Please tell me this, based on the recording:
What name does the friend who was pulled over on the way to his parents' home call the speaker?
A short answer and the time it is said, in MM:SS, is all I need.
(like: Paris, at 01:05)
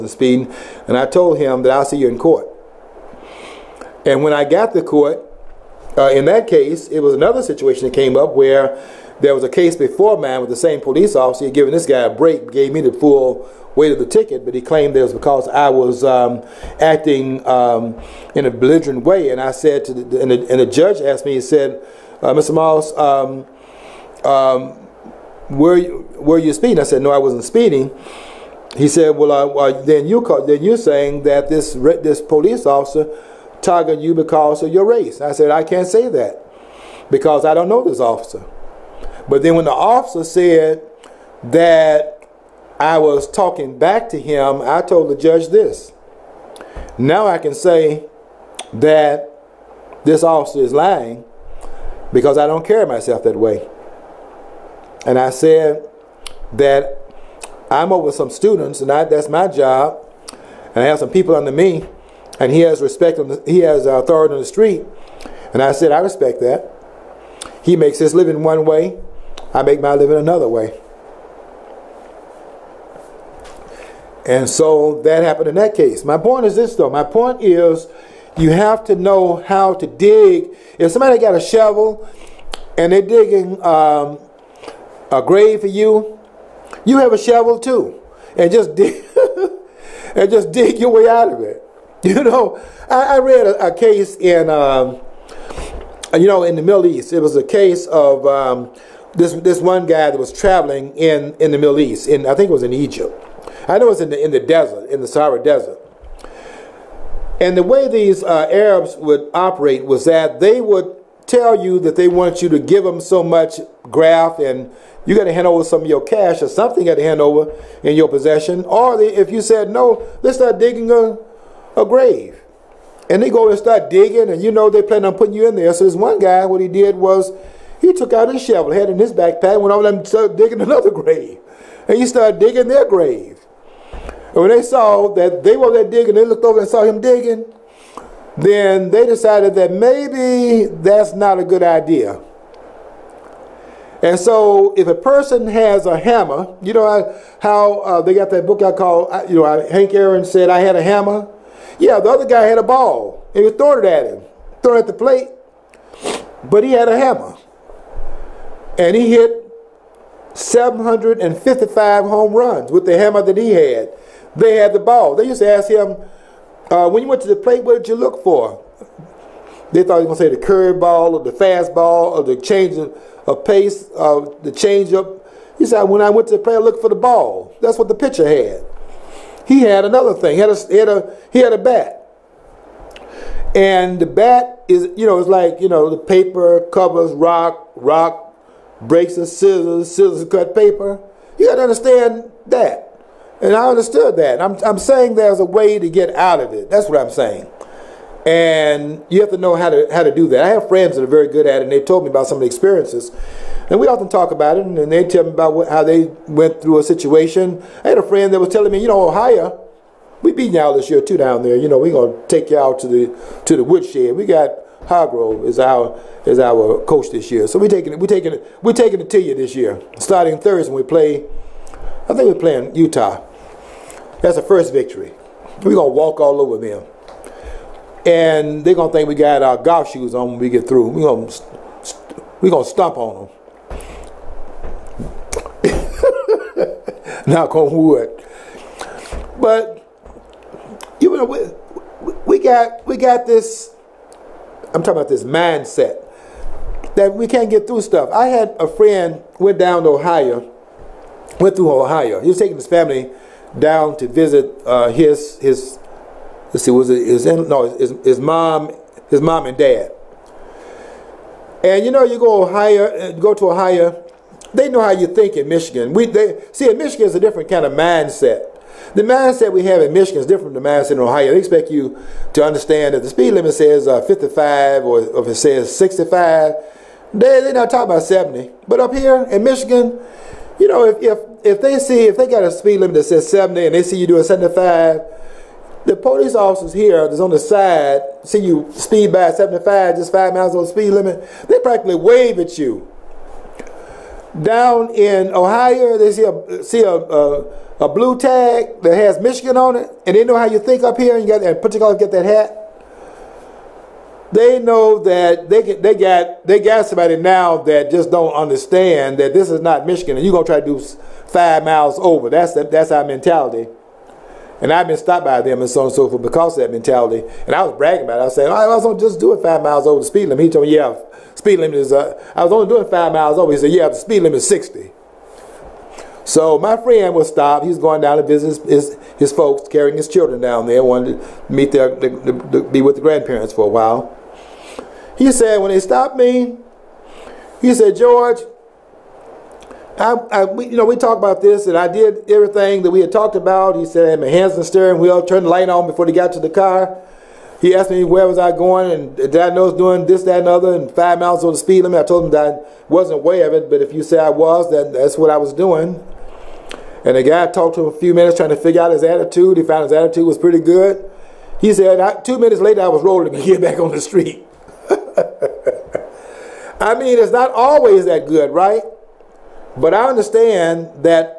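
George, at 05:37.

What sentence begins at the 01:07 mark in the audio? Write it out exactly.
He makes his living one way, I make my living another way.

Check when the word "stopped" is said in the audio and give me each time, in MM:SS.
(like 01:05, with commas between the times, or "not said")
05:14, 05:27, 05:35.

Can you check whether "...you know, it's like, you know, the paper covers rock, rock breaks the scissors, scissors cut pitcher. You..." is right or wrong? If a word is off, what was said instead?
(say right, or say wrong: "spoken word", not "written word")
wrong: "paper", not "pitcher".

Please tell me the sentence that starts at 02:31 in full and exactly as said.
Yeah, the other guy had a ball.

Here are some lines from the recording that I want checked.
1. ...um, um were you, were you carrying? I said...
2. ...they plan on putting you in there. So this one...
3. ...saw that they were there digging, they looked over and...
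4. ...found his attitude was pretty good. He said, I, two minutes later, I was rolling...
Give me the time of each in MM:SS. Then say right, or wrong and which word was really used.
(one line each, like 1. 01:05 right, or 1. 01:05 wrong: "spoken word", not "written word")
1. 00:22 wrong: "speeding", not "carrying"
2. 02:04 right
3. 02:14 right
4. 05:59 right.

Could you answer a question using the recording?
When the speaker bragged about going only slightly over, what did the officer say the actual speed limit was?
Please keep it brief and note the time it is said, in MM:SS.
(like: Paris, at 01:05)
60, at 05:24.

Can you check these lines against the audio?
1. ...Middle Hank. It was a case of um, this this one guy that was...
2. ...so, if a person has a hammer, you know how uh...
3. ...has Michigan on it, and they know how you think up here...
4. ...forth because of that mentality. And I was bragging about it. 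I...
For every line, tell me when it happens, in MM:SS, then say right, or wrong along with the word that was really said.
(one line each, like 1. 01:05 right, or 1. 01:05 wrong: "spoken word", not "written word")
1. 01:36 wrong: "East", not "Hank"
2. 02:24 right
3. 04:58 right
4. 05:16 right.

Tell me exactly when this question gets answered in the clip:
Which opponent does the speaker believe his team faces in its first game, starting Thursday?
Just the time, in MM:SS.
03:42.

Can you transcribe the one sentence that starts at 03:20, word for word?
I have friends that are very good at it, and they told me about some of the experiences.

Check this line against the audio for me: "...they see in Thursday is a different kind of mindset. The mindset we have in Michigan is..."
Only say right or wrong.
wrong.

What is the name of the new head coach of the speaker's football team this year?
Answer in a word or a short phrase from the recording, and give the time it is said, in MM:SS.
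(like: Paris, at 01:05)
Harbaugh, at 03:34.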